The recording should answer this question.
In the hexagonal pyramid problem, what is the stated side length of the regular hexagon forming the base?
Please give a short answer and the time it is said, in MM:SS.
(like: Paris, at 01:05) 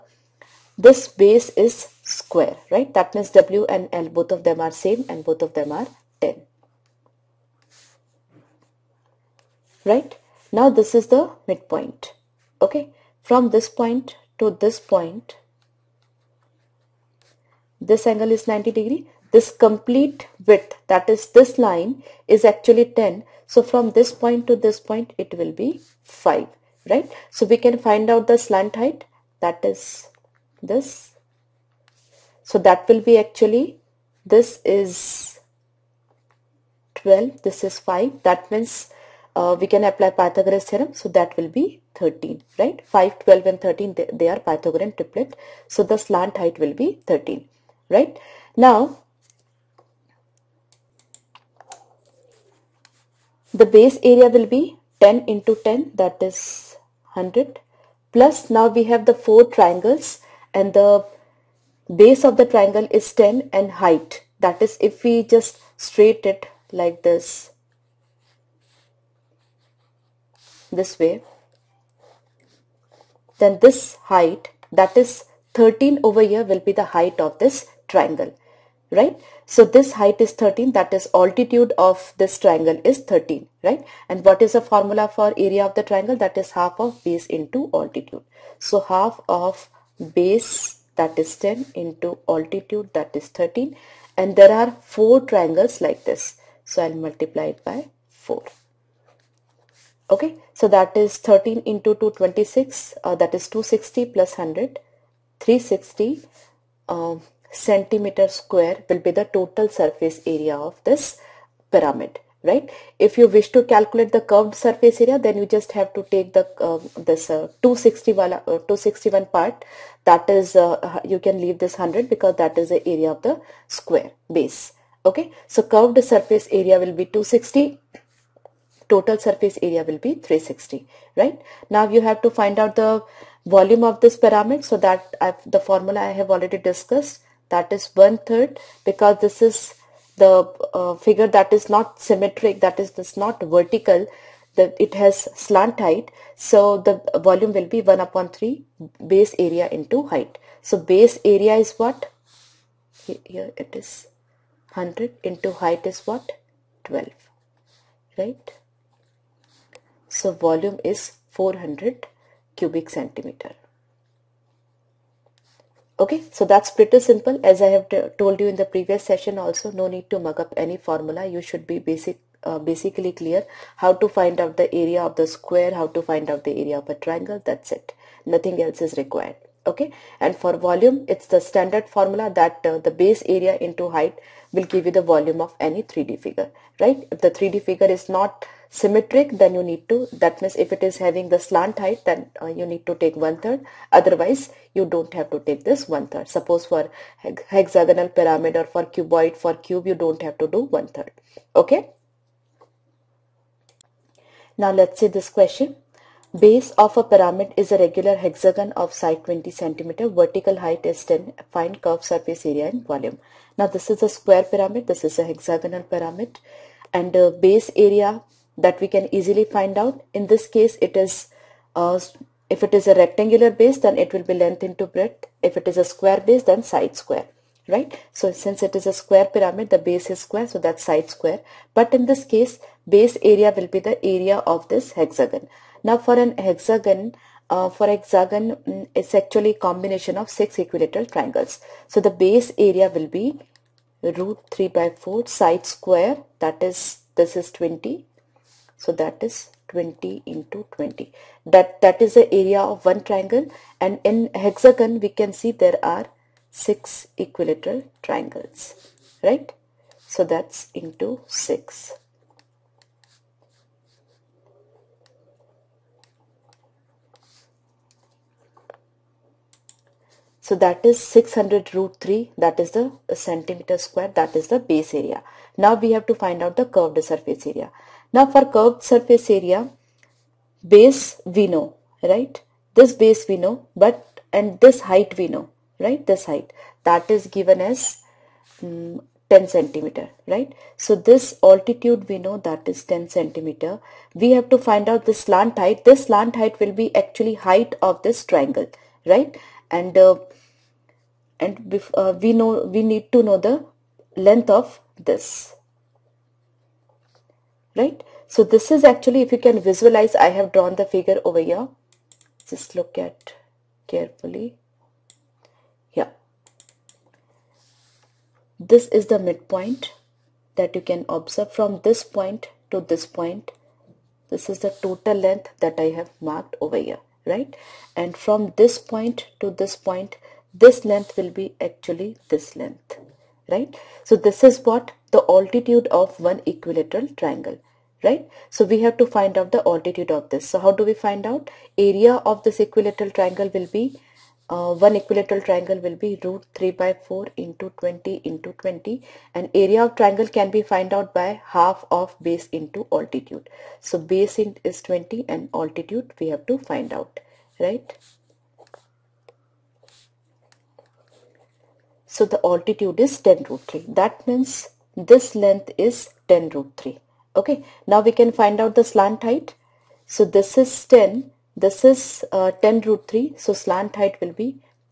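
20 cm, at 03:28.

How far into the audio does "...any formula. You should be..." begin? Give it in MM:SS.
02:50.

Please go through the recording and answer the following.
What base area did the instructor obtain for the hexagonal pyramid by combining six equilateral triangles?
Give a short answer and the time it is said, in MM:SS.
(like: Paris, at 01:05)
600 root 3 square centimetres, at 04:31.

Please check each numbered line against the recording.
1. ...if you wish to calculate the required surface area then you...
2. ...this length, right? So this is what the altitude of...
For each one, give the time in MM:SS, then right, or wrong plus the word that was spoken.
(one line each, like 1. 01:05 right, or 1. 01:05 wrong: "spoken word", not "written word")
1. 01:53 wrong: "curved", not "required"
2. 05:32 right.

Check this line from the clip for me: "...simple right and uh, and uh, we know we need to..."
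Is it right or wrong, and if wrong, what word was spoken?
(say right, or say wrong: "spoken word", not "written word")
wrong: "triangle", not "simple".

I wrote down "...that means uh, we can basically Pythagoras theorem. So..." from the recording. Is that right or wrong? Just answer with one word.
wrong.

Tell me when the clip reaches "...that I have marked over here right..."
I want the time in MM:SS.
05:25.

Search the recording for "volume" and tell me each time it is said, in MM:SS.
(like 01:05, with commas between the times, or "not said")
02:13, 02:27, 02:40, 03:00, 03:05, 03:32.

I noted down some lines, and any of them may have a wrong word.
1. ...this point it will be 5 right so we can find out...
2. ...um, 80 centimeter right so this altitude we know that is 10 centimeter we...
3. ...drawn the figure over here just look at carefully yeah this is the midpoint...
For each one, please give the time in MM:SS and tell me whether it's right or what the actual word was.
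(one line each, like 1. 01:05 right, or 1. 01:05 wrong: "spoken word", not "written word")
1. 00:24 right
2. 04:48 wrong: "10", not "80"
3. 05:10 right.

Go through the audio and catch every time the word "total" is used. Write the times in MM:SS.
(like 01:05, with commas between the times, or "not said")
01:49, 02:08, 05:24.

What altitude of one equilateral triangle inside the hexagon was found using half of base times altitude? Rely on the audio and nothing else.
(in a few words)
10 root 3.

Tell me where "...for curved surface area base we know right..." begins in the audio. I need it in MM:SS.
04:38.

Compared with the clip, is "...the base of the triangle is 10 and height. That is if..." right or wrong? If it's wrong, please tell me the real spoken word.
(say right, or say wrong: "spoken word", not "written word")
right.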